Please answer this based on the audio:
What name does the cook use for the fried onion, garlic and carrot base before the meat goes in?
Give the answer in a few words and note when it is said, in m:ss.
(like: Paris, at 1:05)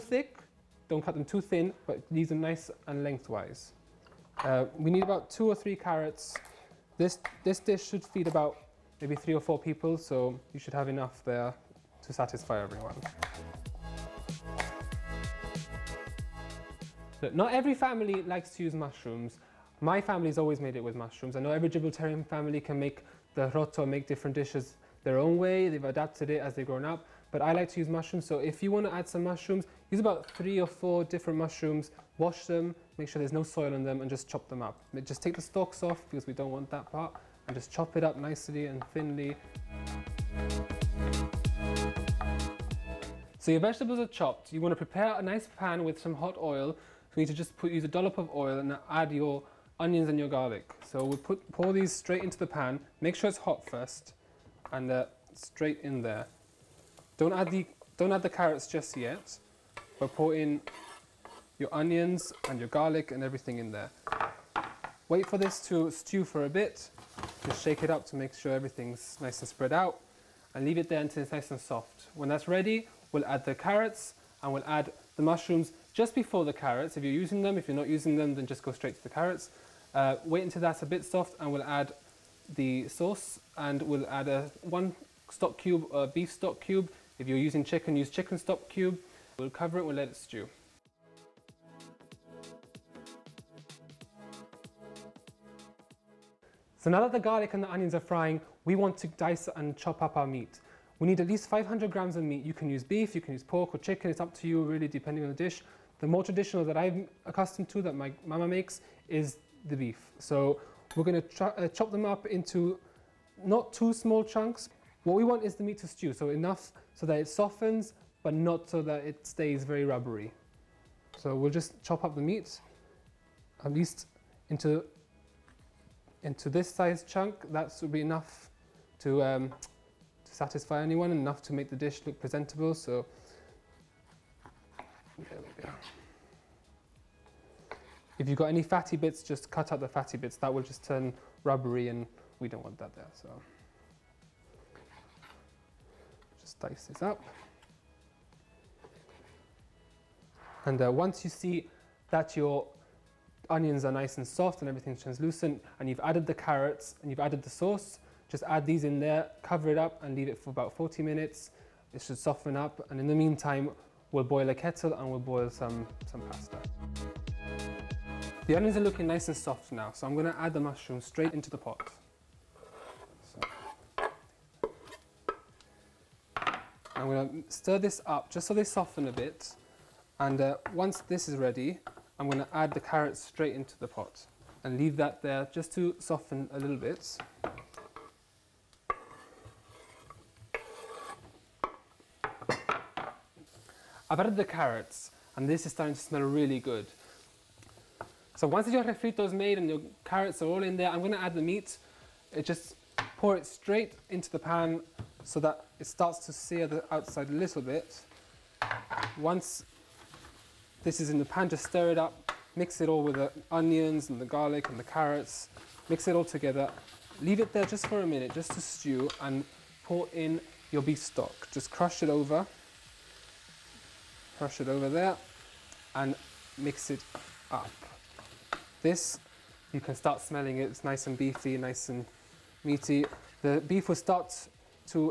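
refrito, at 3:18.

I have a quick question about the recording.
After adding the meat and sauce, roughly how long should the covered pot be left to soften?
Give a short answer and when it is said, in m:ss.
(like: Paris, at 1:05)
40 minutes, at 2:40.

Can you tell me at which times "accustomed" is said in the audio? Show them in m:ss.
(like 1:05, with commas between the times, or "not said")
1:47.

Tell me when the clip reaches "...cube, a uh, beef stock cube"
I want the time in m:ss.
1:25.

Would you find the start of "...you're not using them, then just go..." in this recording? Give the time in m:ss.
1:17.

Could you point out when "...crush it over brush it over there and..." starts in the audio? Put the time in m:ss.
3:41.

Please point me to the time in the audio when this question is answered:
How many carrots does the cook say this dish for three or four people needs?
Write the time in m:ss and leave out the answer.
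0:05.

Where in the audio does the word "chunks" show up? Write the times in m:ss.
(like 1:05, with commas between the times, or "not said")
1:54, 2:07.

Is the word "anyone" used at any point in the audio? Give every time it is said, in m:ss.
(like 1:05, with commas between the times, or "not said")
2:10.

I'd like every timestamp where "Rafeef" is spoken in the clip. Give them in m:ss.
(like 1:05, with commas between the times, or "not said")
not said.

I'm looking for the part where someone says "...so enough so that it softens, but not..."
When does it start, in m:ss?
1:56.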